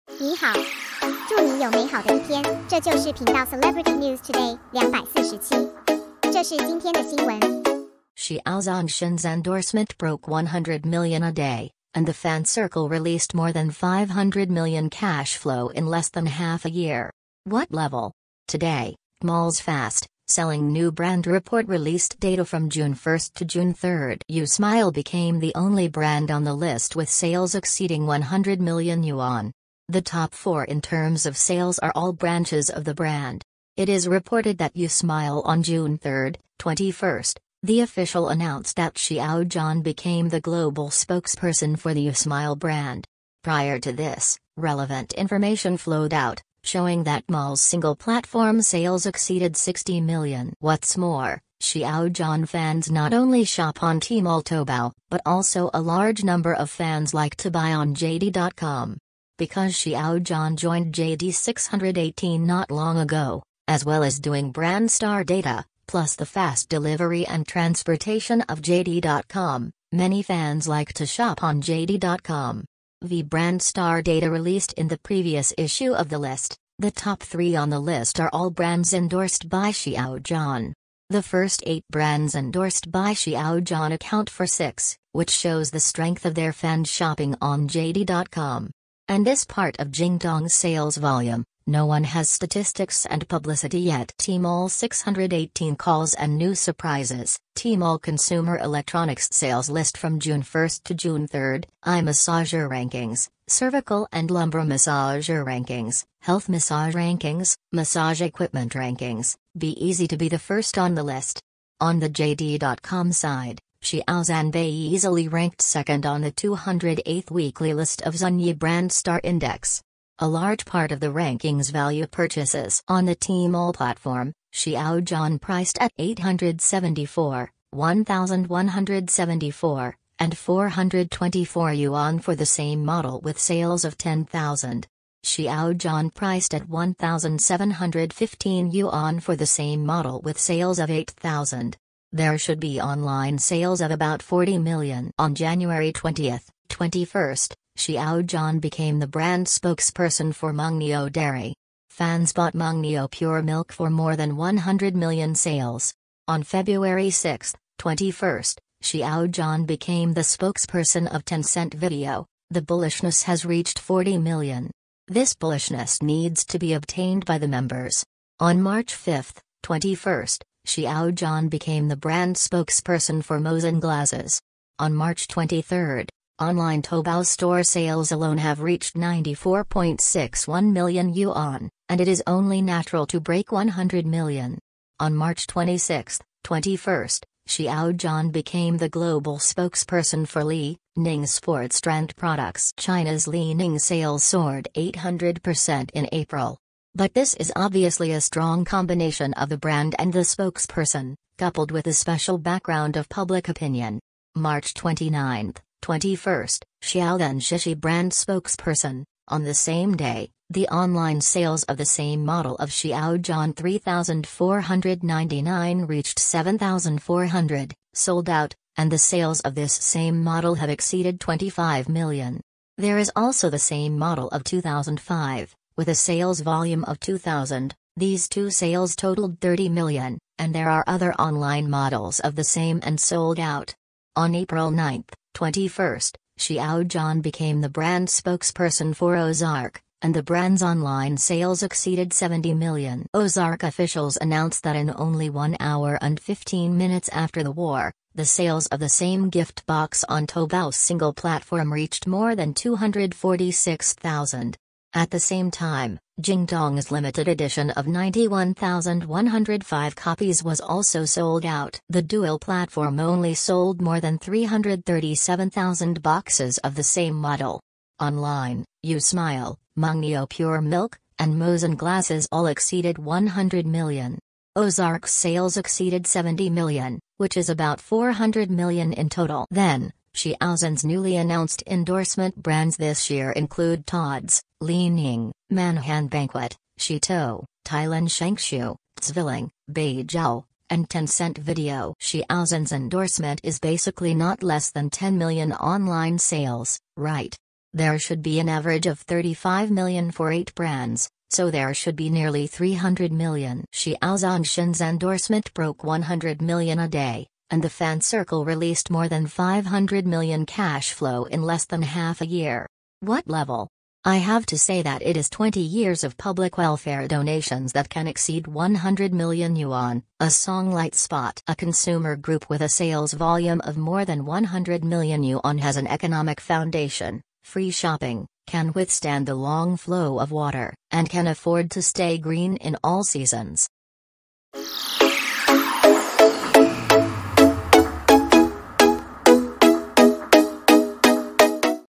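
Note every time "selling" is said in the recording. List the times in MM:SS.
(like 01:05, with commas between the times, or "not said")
00:20.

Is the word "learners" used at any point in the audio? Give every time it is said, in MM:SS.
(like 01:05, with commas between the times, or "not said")
not said.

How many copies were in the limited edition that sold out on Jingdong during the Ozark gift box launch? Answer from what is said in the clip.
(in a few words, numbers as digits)
91,105.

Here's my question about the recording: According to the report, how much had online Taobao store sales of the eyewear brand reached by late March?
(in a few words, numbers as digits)
94.61 million yuan.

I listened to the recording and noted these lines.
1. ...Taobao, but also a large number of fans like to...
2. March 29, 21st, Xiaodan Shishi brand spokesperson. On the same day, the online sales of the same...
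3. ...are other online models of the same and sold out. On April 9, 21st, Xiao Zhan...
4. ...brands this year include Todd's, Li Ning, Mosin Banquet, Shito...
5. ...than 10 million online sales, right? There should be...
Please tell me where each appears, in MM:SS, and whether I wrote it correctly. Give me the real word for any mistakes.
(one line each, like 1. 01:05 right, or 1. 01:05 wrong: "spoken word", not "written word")
1. 00:54 right
2. 03:24 right
3. 03:50 right
4. 04:42 wrong: "Manhan", not "Mosin"
5. 04:54 right.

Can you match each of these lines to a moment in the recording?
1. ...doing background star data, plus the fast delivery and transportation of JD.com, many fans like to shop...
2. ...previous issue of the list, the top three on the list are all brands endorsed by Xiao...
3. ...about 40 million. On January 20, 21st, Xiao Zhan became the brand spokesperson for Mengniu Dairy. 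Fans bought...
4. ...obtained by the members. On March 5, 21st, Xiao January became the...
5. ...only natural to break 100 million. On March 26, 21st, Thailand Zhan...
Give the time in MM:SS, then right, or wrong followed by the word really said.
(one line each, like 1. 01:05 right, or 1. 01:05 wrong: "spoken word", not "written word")
1. 01:04 wrong: "brand", not "background"
2. 01:14 right
3. 02:23 right
4. 02:46 wrong: "Zhan", not "January"
5. 03:02 wrong: "Xiao", not "Thailand".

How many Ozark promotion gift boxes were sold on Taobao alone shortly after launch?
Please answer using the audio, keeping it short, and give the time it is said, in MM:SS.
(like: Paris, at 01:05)
246,000, at 04:12.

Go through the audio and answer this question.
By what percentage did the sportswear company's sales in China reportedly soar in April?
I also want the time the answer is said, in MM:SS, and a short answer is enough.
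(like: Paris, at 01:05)
800%, at 03:14.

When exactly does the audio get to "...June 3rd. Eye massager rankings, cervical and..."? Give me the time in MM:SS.
01:40.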